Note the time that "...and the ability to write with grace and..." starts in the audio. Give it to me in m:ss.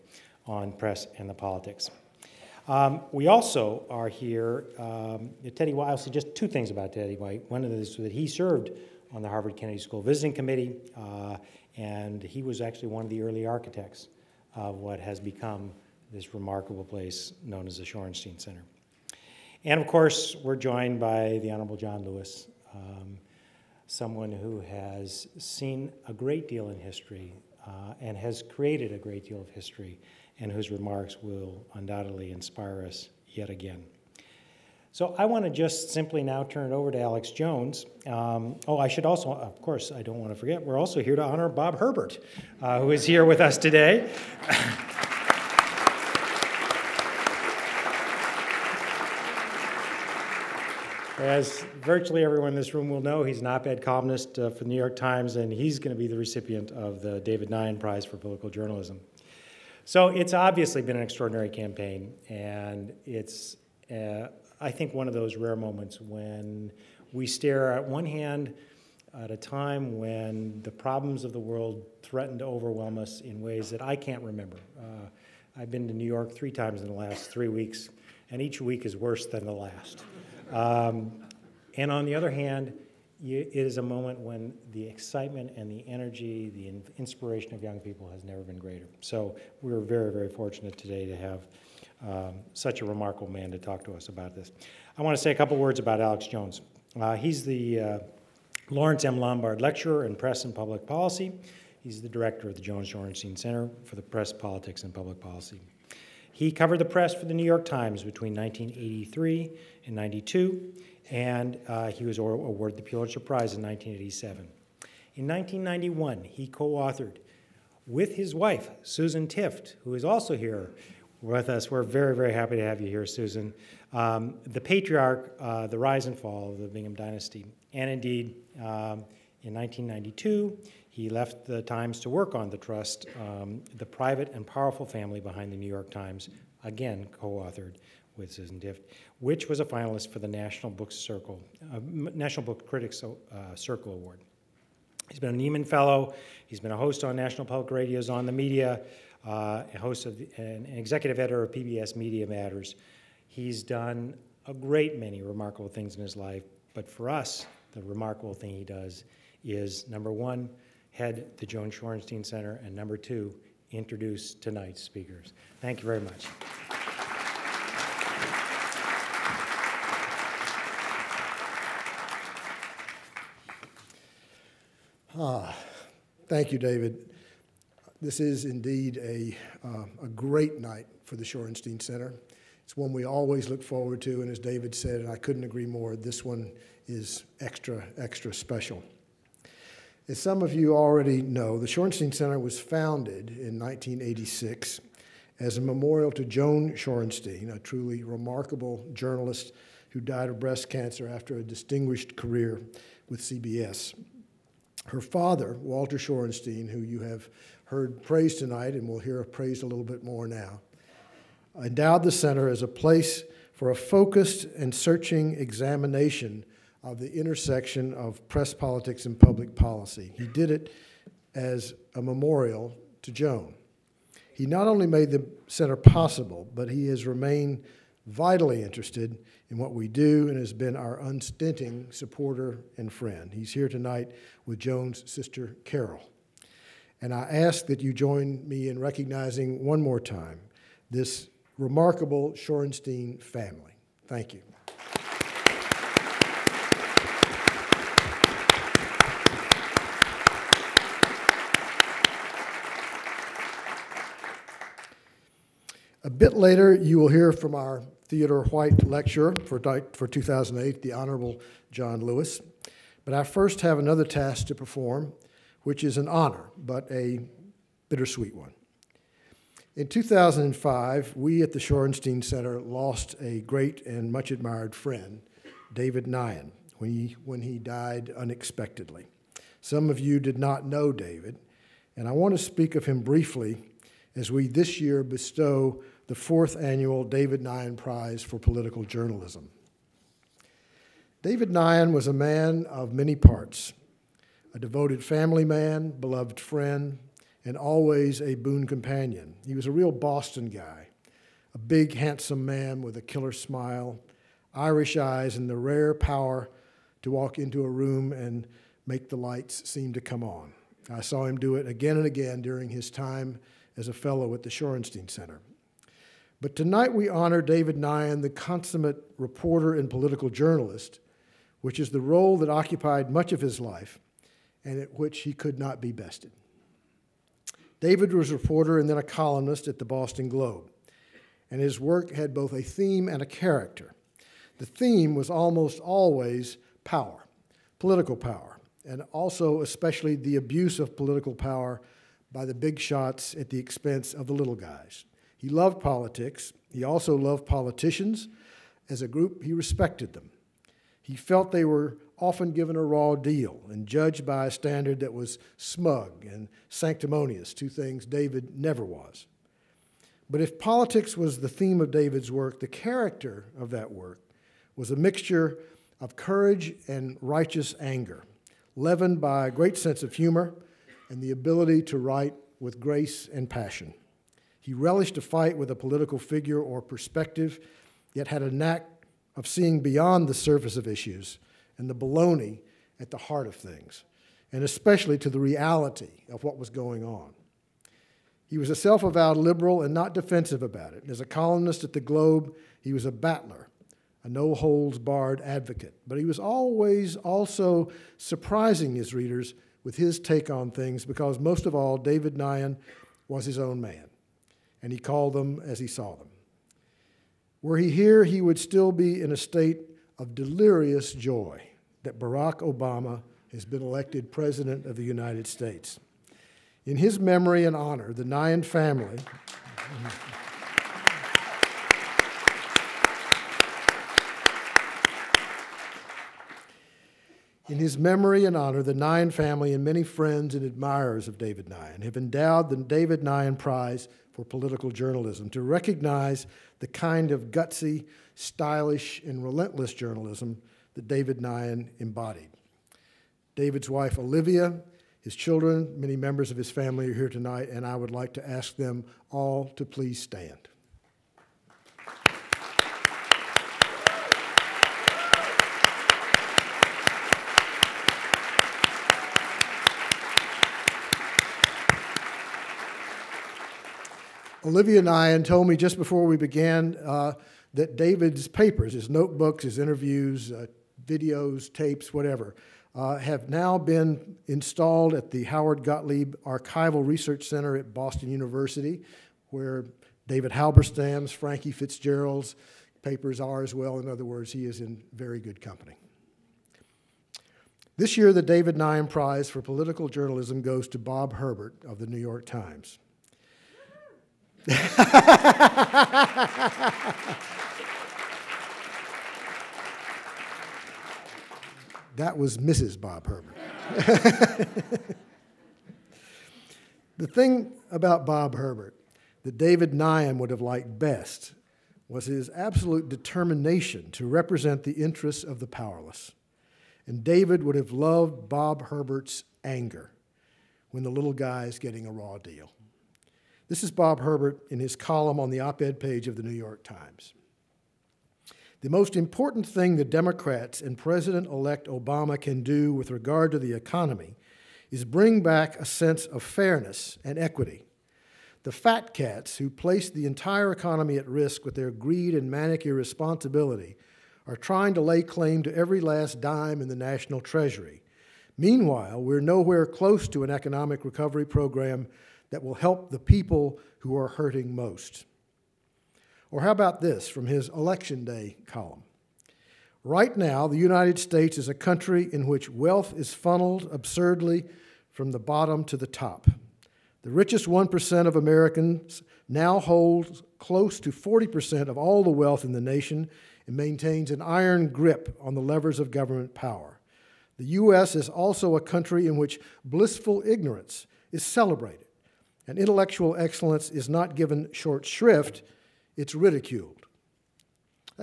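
6:11.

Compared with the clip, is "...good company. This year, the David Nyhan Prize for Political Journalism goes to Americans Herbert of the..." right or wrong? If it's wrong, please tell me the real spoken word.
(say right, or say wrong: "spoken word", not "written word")
wrong: "Bob", not "Americans".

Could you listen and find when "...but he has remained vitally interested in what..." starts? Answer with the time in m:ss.
3:46.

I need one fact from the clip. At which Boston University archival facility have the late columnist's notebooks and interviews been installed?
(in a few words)
Howard Gottlieb Archival Research Center.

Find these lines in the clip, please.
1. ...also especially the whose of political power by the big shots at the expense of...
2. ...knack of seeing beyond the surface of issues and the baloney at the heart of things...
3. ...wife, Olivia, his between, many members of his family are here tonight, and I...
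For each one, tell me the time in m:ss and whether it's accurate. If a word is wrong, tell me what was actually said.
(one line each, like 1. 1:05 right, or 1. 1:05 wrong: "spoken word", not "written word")
1. 5:39 wrong: "abuse", not "whose"
2. 6:18 right
3. 7:23 wrong: "children", not "between".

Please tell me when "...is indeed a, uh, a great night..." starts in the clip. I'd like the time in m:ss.
2:58.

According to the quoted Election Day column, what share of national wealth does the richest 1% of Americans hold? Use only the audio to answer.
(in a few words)
close to 40%.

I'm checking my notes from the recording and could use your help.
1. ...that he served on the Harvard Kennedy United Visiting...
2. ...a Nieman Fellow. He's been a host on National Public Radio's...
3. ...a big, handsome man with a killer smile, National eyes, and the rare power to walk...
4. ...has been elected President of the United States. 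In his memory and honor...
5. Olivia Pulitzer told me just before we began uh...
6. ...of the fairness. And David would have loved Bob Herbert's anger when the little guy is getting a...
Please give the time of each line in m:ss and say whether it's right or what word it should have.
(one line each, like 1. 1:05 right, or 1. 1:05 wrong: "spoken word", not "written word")
1. 0:07 wrong: "School", not "United"
2. 2:25 right
3. 5:01 wrong: "Irish", not "National"
4. 6:53 right
5. 7:44 wrong: "Nyhan", not "Pulitzer"
6. 8:35 wrong: "powerless", not "fairness".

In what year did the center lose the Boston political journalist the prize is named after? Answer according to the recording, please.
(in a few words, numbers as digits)
2005.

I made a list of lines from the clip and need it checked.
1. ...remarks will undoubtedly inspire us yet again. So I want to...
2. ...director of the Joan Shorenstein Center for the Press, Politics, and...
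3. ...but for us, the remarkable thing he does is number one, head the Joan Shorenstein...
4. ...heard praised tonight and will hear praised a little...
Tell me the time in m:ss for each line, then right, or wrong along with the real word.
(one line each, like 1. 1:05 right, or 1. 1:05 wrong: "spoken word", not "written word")
1. 0:30 right
2. 1:42 right
3. 2:36 right
4. 3:27 right.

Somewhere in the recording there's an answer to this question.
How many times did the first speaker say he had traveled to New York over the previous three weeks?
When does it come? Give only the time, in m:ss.
1:16.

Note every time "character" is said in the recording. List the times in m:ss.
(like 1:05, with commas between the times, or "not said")
5:33, 6:02.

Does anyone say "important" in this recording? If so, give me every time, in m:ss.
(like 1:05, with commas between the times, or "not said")
8:49.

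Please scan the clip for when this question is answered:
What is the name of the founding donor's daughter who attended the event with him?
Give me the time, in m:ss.
3:55.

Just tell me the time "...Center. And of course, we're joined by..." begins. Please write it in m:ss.
0:18.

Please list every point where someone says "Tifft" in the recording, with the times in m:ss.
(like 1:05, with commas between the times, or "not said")
1:59, 2:18.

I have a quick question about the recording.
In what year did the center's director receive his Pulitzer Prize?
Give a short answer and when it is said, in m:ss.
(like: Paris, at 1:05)
1987, at 1:53.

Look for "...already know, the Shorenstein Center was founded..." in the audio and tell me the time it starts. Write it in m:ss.
3:10.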